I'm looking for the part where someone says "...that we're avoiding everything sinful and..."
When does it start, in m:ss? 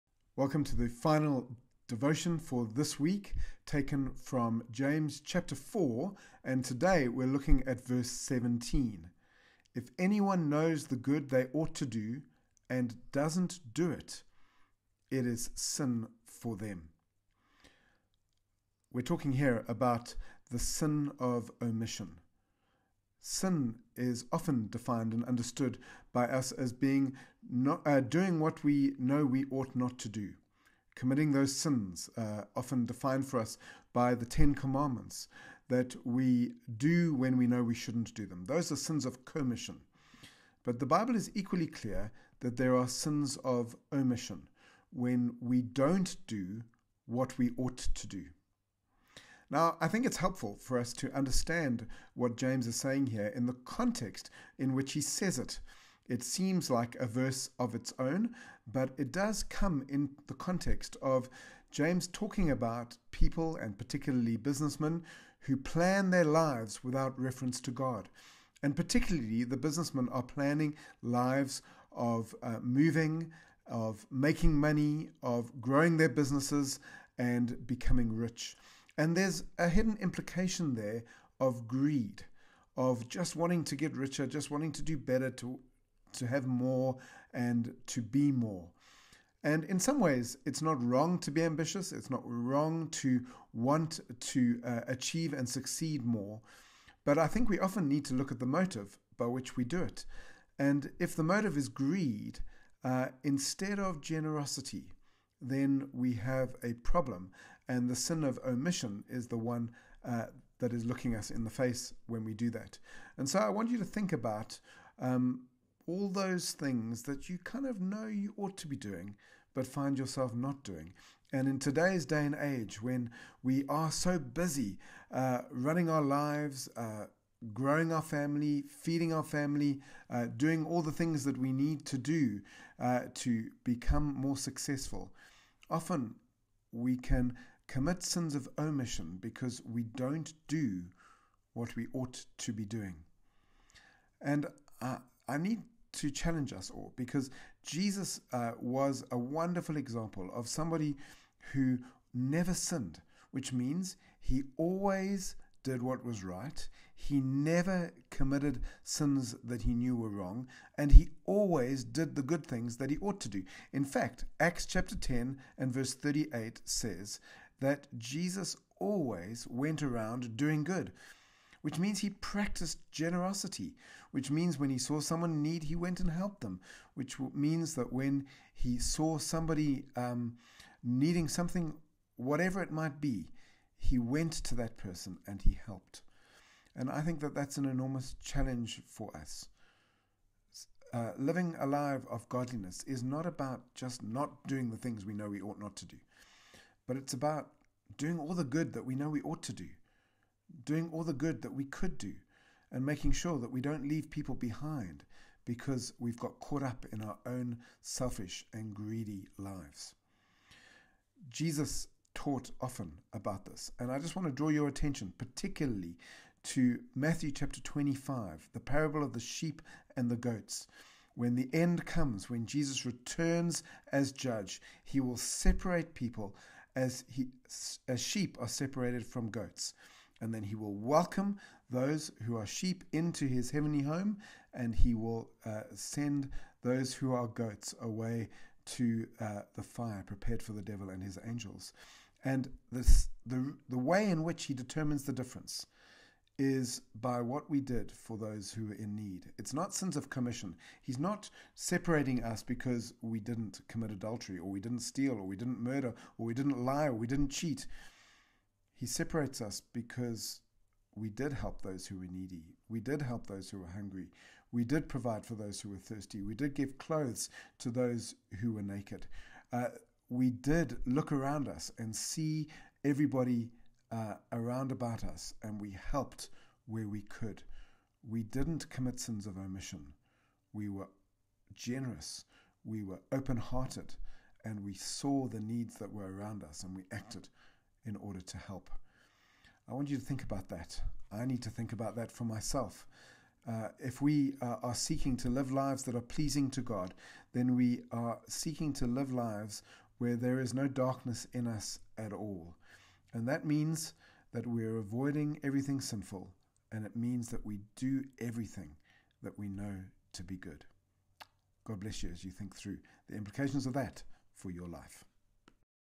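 5:04.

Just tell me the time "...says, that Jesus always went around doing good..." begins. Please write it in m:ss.
2:46.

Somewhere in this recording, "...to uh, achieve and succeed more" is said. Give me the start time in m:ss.
1:34.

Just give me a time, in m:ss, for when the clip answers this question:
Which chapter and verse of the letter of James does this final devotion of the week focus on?
0:04.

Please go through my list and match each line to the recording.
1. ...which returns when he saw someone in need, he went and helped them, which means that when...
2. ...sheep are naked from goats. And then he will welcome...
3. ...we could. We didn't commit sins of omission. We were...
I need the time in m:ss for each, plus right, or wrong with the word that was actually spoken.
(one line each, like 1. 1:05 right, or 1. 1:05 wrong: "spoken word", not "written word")
1. 2:54 wrong: "means", not "returns"
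2. 3:48 wrong: "separated", not "naked"
3. 4:36 right.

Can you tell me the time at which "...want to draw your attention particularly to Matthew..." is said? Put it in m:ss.
3:34.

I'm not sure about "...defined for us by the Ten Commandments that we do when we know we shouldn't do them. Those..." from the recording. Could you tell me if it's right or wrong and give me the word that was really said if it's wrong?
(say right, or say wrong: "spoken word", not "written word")
right.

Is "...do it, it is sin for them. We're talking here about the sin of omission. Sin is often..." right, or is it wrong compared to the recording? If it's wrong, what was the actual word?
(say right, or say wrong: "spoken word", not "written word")
right.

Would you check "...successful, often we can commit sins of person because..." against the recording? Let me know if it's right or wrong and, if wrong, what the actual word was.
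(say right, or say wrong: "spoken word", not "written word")
wrong: "omission", not "person".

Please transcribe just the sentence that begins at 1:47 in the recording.
And the sin of omission is the one uh, that is looking us in the face when we do that.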